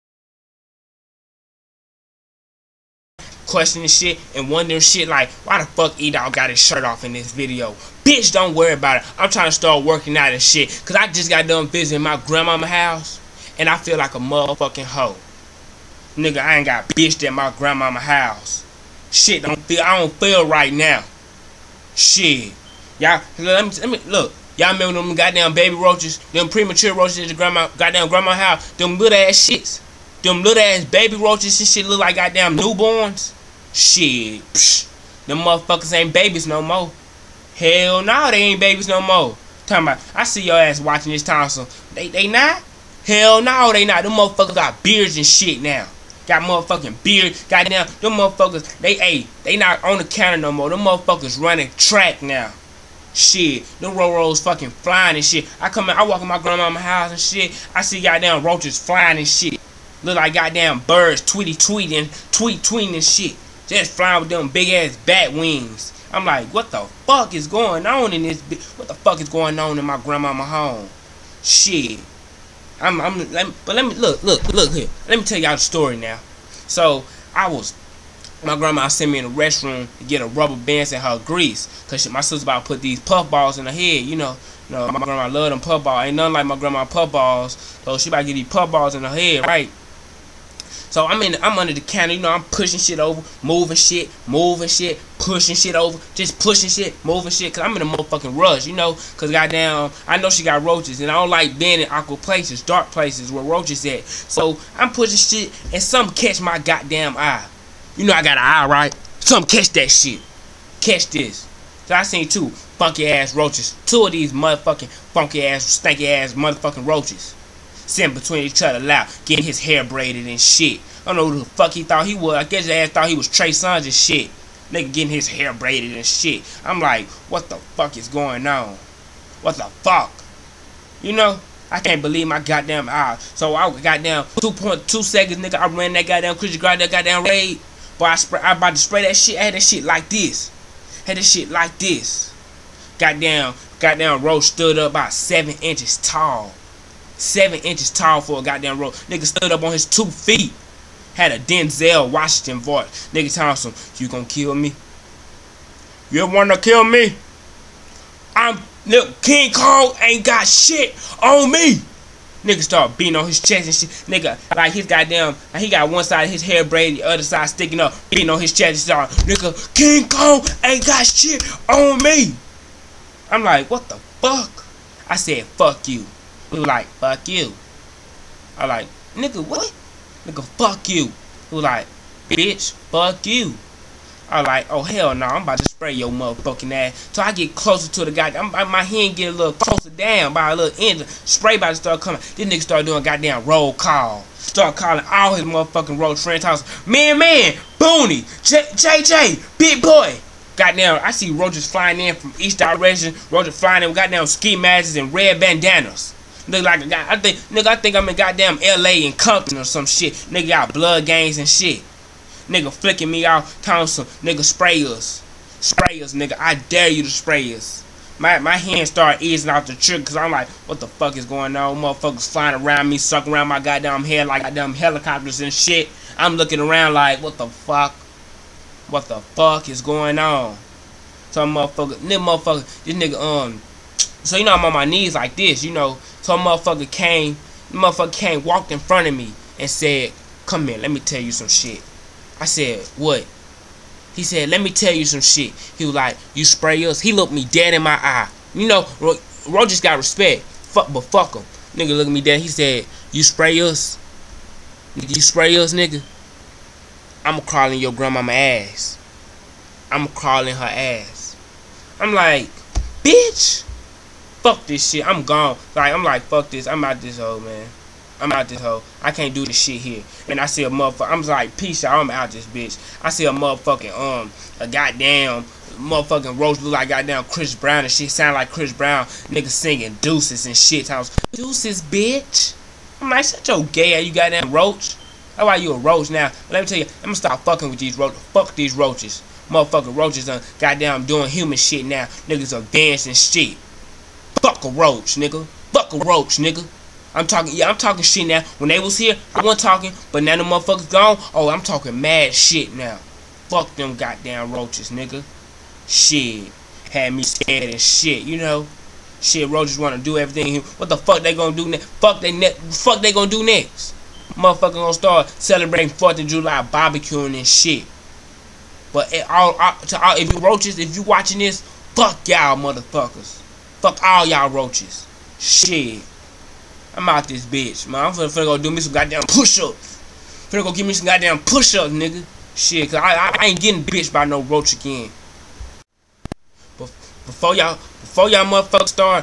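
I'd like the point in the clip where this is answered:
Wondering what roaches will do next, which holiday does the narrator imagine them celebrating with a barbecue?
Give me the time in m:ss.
5:15.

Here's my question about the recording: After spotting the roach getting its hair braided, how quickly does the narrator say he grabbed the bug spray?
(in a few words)
2.2 seconds.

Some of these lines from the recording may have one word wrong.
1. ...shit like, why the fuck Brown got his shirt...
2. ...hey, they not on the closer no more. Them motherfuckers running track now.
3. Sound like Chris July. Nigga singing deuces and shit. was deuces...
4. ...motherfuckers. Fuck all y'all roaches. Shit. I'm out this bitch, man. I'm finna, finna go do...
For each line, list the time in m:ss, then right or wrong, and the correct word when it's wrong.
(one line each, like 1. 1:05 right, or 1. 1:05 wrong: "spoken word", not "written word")
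1. 0:04 wrong: "Edol", not "Brown"
2. 0:48 wrong: "counter", not "closer"
3. 4:38 wrong: "Brown", not "July"
4. 5:22 right.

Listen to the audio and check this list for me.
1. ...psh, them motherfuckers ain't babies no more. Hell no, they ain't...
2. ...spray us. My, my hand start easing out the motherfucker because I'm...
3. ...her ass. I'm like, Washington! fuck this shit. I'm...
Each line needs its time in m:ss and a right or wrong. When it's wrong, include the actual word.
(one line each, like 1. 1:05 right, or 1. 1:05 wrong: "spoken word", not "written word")
1. 0:34 right
2. 3:37 wrong: "trigger", not "motherfucker"
3. 4:20 wrong: "Bitch", not "Washington".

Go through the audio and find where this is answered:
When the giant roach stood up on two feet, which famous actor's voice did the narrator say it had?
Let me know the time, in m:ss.
2:31.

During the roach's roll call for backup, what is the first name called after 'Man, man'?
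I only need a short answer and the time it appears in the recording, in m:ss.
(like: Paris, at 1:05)
Booney, at 3:17.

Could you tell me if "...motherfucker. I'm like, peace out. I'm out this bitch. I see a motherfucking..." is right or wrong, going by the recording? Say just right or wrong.
right.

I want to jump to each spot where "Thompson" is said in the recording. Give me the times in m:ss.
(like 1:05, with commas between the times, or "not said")
0:41, 2:33.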